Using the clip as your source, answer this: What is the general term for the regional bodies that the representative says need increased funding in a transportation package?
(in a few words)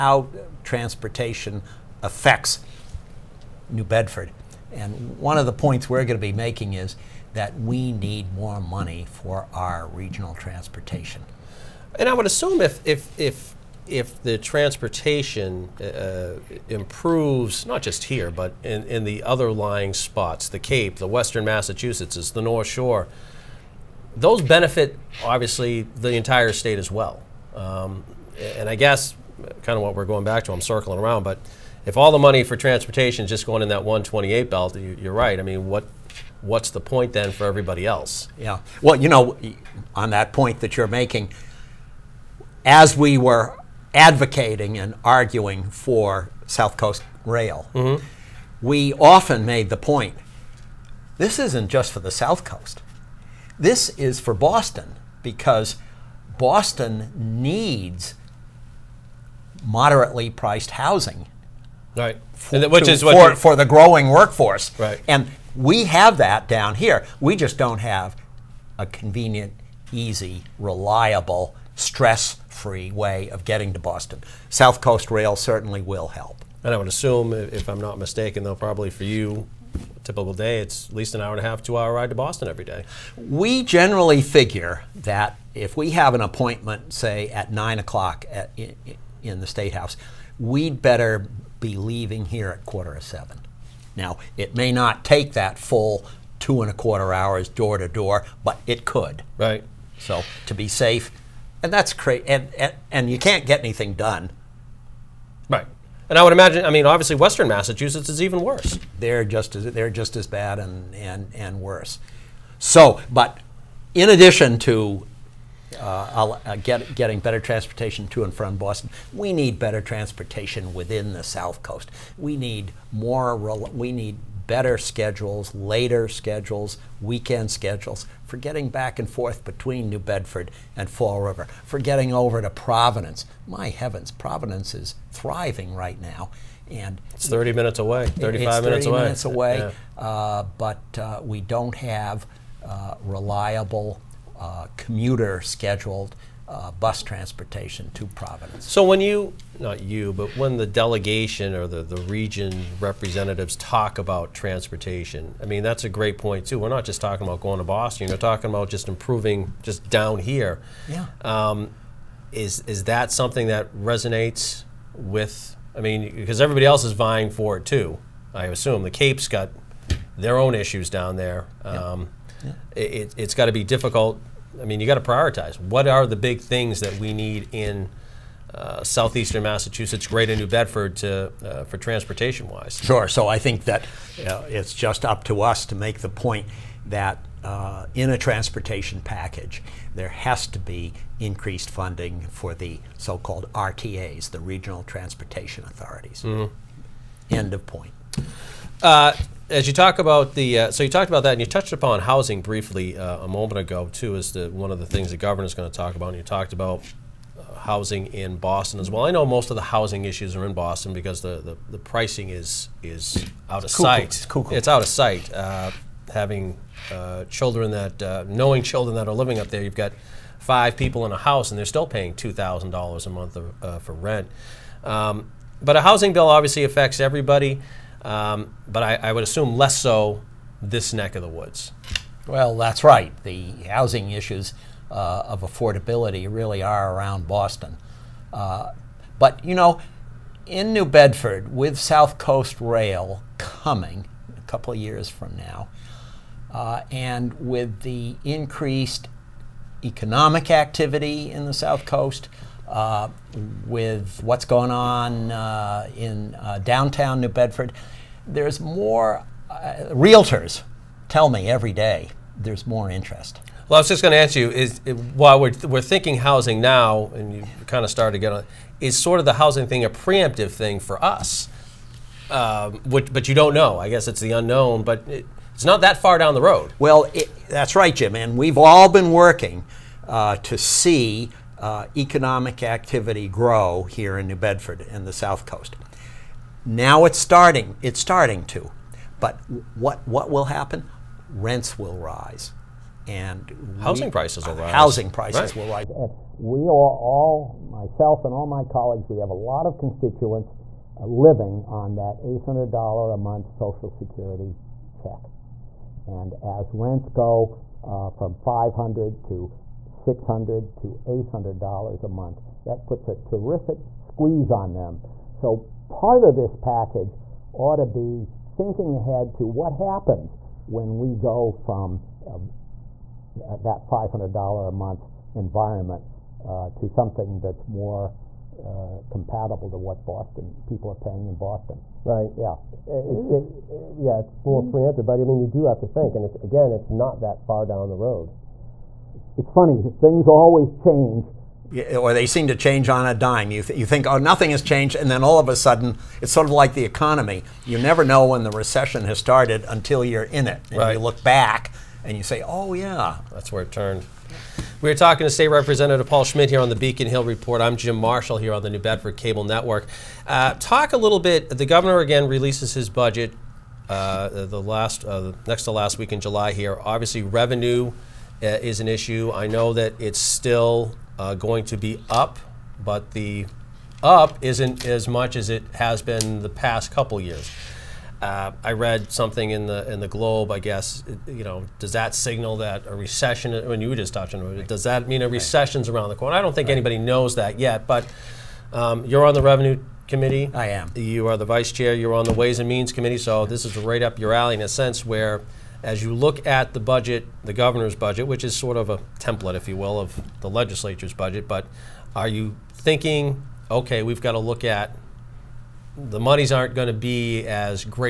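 Regional Transportation Authorities.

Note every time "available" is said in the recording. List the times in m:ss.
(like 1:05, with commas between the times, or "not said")
not said.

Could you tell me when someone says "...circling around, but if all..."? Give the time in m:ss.
0:30.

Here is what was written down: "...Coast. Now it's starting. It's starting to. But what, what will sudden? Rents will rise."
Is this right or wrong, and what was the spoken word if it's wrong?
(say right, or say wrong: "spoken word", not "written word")
wrong: "happen", not "sudden".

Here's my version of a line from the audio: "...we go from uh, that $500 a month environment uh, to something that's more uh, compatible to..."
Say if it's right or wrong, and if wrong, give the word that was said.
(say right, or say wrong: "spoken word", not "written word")
right.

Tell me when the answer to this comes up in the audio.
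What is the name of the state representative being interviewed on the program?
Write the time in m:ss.
5:56.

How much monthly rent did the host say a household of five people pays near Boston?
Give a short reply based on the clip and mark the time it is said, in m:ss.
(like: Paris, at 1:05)
$2,000, at 3:42.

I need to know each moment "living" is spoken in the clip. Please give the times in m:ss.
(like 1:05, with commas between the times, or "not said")
3:39, 5:01.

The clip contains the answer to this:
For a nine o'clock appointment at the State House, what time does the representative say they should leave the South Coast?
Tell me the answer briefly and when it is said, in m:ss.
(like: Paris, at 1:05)
quarter of seven, at 1:32.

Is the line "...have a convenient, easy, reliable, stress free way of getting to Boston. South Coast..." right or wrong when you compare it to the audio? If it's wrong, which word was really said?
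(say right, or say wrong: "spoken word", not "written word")
right.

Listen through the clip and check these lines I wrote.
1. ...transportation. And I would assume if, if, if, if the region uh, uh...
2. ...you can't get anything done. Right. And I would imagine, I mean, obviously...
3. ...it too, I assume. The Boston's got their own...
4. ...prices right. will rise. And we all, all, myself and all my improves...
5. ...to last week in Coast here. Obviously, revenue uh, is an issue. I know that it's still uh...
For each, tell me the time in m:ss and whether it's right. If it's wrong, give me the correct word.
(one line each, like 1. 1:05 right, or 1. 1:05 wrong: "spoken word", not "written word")
1. 0:10 wrong: "transportation", not "region"
2. 1:43 right
3. 2:47 wrong: "Cape", not "Boston"
4. 4:55 wrong: "colleagues", not "improves"
5. 6:05 wrong: "July", not "Coast".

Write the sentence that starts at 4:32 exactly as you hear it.
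Um, which, but you don't know.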